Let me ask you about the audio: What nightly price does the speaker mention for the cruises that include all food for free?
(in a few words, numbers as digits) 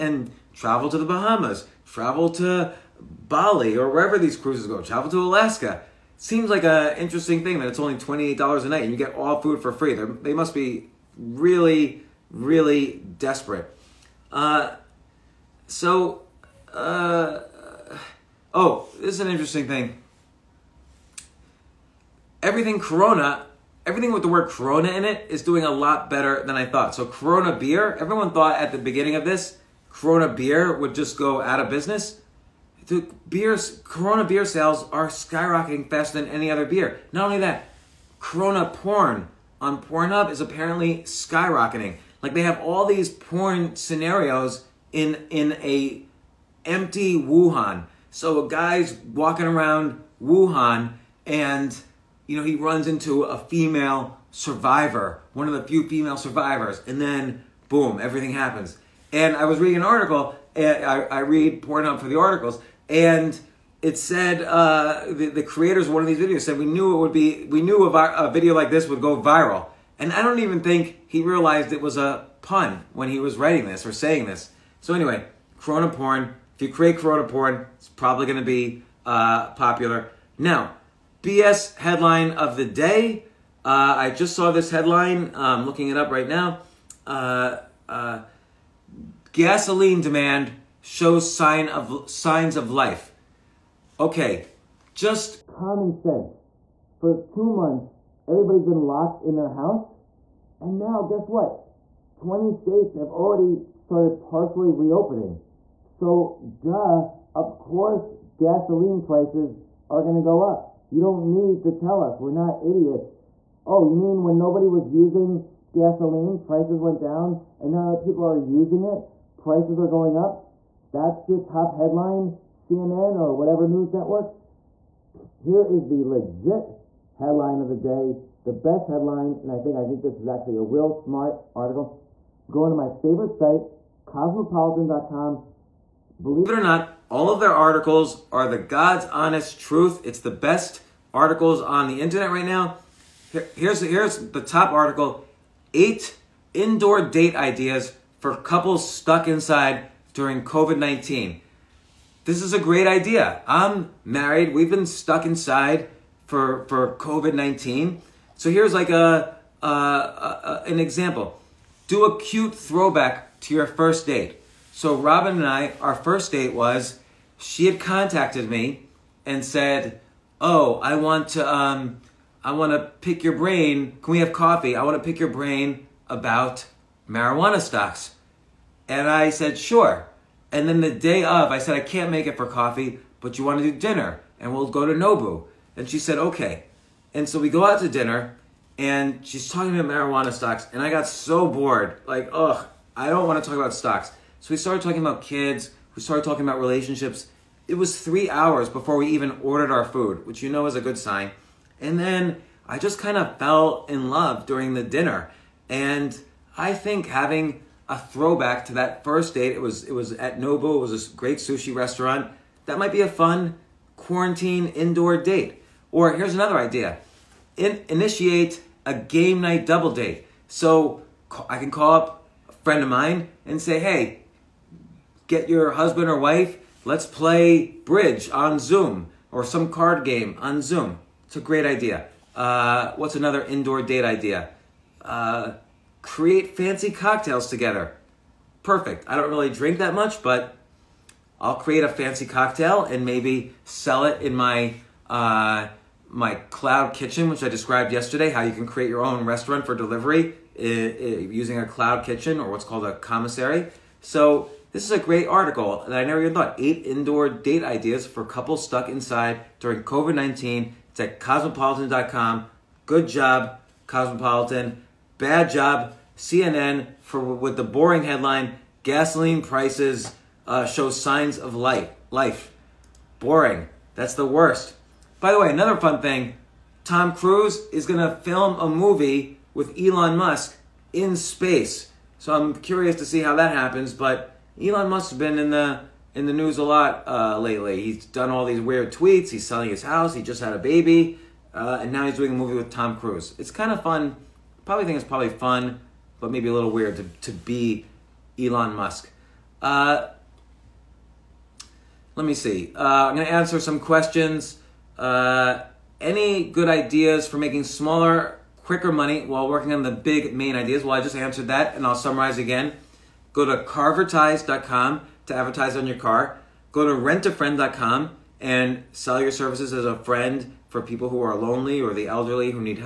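$28.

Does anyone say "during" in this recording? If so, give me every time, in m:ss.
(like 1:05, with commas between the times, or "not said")
2:30, 3:24, 4:19.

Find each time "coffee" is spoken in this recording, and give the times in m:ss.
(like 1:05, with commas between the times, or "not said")
2:54, 3:02.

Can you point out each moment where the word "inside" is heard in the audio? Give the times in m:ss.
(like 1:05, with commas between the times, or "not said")
2:29, 2:35, 4:18.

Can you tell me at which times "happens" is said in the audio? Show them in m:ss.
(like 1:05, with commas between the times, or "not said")
0:58, 4:43.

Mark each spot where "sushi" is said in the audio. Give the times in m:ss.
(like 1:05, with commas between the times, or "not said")
3:31.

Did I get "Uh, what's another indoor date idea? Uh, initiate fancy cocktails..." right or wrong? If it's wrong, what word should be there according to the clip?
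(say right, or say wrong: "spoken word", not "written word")
wrong: "create", not "initiate".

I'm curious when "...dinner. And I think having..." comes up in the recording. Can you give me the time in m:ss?
3:24.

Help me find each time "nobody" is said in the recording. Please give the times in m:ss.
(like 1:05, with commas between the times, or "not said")
1:54.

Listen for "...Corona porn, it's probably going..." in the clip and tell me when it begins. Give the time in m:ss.
1:16.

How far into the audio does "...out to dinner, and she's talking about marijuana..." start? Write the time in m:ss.
3:07.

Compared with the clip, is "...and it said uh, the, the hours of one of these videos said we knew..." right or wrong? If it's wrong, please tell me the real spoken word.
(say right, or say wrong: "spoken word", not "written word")
wrong: "creators", not "hours".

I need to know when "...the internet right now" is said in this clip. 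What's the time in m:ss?
2:21.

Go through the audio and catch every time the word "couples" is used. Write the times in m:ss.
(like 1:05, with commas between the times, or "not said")
2:28, 4:18.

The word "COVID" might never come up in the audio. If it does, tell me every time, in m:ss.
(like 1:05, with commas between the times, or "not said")
2:30, 2:36, 4:19.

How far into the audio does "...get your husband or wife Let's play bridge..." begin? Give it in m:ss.
3:45.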